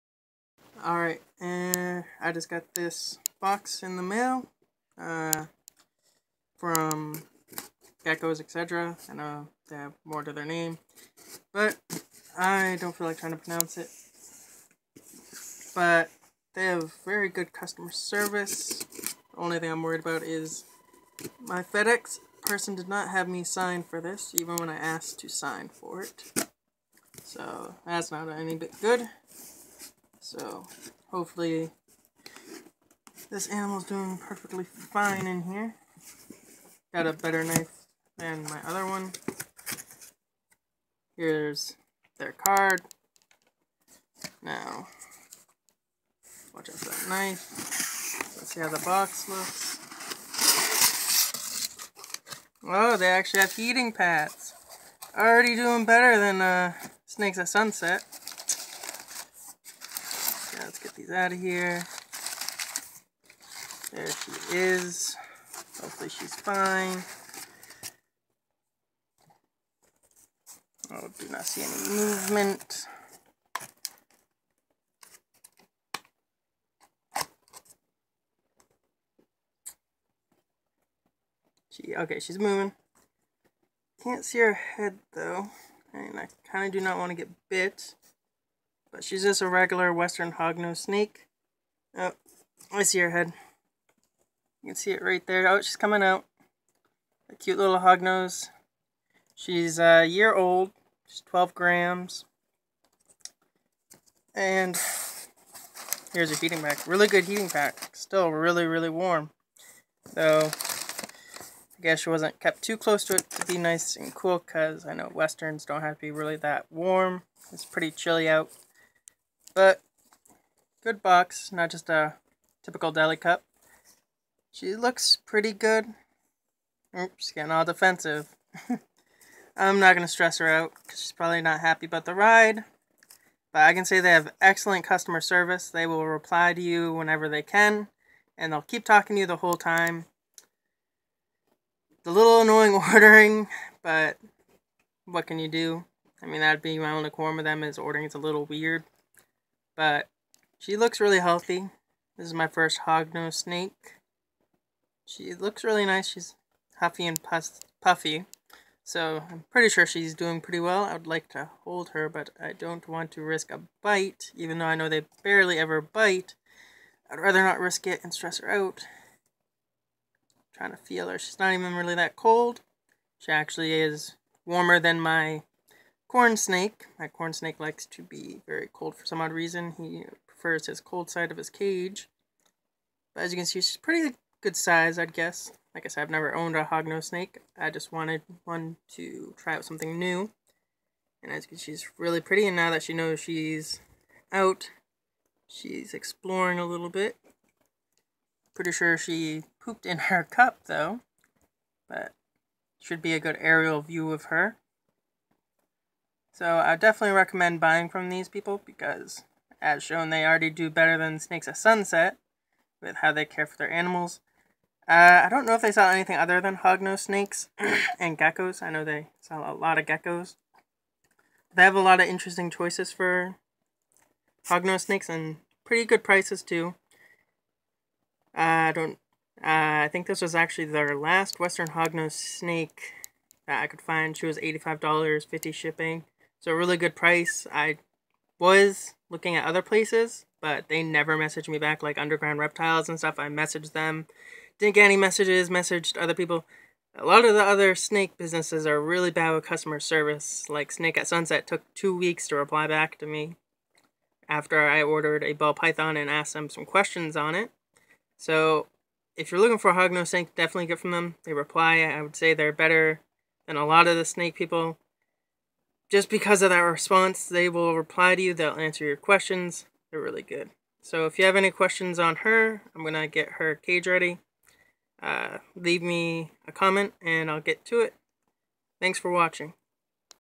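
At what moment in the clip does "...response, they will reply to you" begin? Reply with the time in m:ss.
4:26.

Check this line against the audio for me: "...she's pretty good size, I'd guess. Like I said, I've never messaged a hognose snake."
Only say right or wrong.
wrong.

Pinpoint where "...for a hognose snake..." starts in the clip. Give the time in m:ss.
4:19.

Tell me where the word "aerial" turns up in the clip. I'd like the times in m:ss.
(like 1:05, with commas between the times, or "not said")
3:23.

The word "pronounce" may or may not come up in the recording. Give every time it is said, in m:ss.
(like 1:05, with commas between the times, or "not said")
0:13.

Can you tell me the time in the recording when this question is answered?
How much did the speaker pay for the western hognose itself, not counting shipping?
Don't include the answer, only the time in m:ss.
3:54.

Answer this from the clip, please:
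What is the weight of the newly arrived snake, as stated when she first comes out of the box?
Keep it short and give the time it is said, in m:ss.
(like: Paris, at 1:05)
12 grams, at 1:41.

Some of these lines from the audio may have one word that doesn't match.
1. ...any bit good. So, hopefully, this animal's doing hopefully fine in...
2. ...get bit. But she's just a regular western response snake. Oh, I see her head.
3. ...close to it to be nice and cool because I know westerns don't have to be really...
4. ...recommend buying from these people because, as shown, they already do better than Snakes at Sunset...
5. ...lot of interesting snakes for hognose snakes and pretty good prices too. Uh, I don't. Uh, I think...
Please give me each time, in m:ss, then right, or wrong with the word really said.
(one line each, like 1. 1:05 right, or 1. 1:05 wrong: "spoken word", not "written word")
1. 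0:28 wrong: "perfectly", not "hopefully"
2. 1:27 wrong: "hognose", not "response"
3. 1:52 right
4. 3:27 right
5. 3:41 wrong: "choices", not "snakes".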